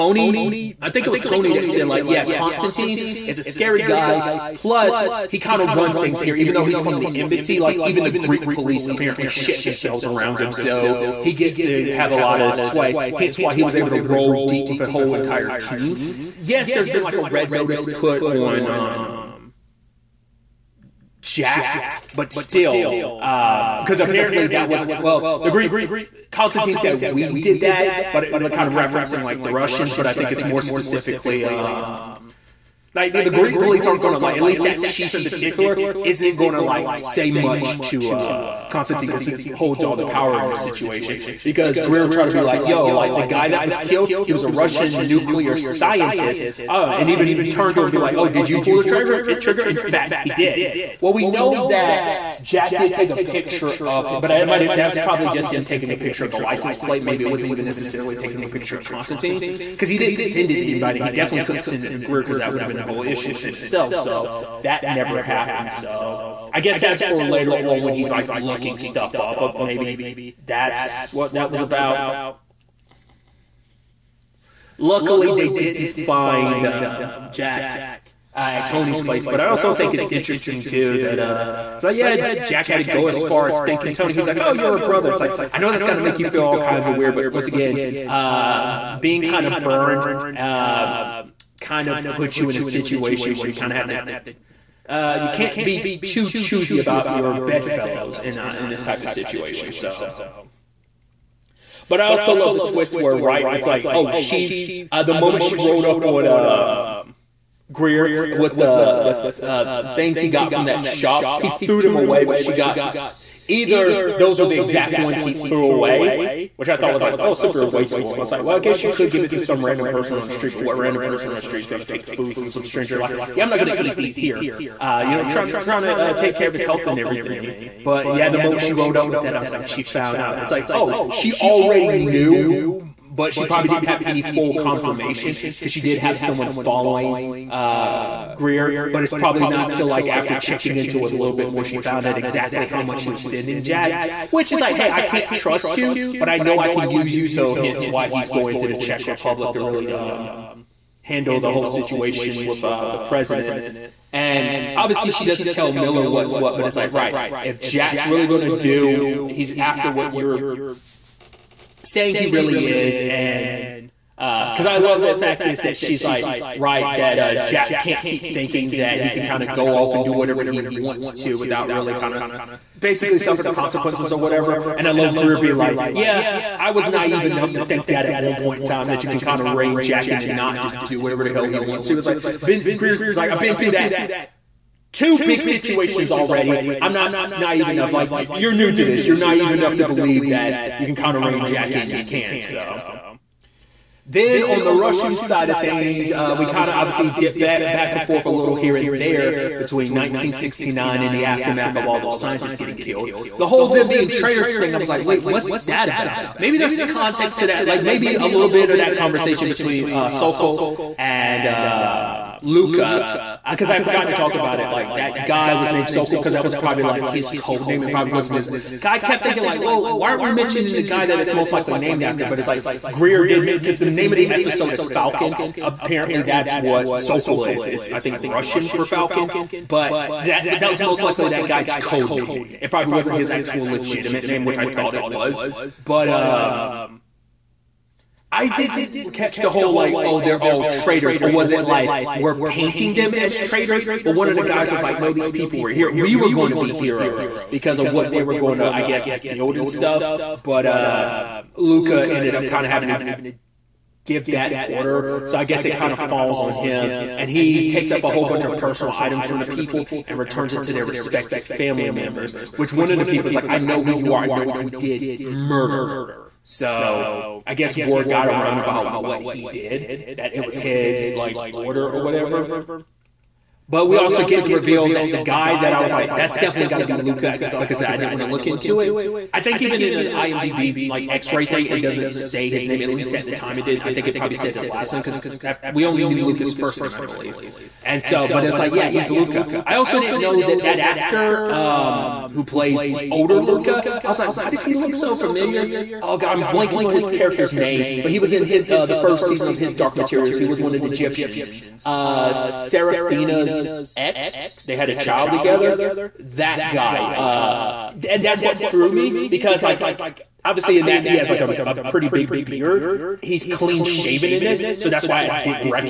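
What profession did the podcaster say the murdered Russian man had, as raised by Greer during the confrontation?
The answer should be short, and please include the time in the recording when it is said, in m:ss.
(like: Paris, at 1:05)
Nuclear scientist, at 0:45.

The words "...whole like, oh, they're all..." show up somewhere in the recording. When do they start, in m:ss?
3:59.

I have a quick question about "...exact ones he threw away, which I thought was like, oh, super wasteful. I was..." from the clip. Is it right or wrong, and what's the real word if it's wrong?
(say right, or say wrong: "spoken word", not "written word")
right.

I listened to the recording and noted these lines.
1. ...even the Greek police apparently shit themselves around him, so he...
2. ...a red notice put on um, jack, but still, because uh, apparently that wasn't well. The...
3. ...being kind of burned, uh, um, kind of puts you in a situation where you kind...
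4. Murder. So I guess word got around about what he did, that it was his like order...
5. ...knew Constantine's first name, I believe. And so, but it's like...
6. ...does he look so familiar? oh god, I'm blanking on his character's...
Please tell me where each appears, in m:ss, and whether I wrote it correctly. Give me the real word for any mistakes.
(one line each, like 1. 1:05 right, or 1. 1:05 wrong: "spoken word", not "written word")
1. 0:07 right
2. 0:17 right
3. 1:28 right
4. 4:25 right
5. 4:46 wrong: "Luca", not "Constantine"
6. 4:54 right.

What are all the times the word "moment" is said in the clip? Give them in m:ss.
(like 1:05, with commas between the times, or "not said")
1:45, 2:08.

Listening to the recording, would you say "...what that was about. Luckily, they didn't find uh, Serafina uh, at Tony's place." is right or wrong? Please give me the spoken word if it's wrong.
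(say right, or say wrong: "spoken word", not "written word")
wrong: "Jack", not "Serafina".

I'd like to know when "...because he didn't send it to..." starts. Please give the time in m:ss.
0:59.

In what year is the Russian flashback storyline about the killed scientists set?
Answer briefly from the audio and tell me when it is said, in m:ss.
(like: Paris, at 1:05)
1969, at 3:19.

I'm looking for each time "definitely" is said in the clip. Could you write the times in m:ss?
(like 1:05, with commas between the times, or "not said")
1:01, 4:36.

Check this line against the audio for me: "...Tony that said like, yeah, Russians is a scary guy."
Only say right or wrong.
wrong.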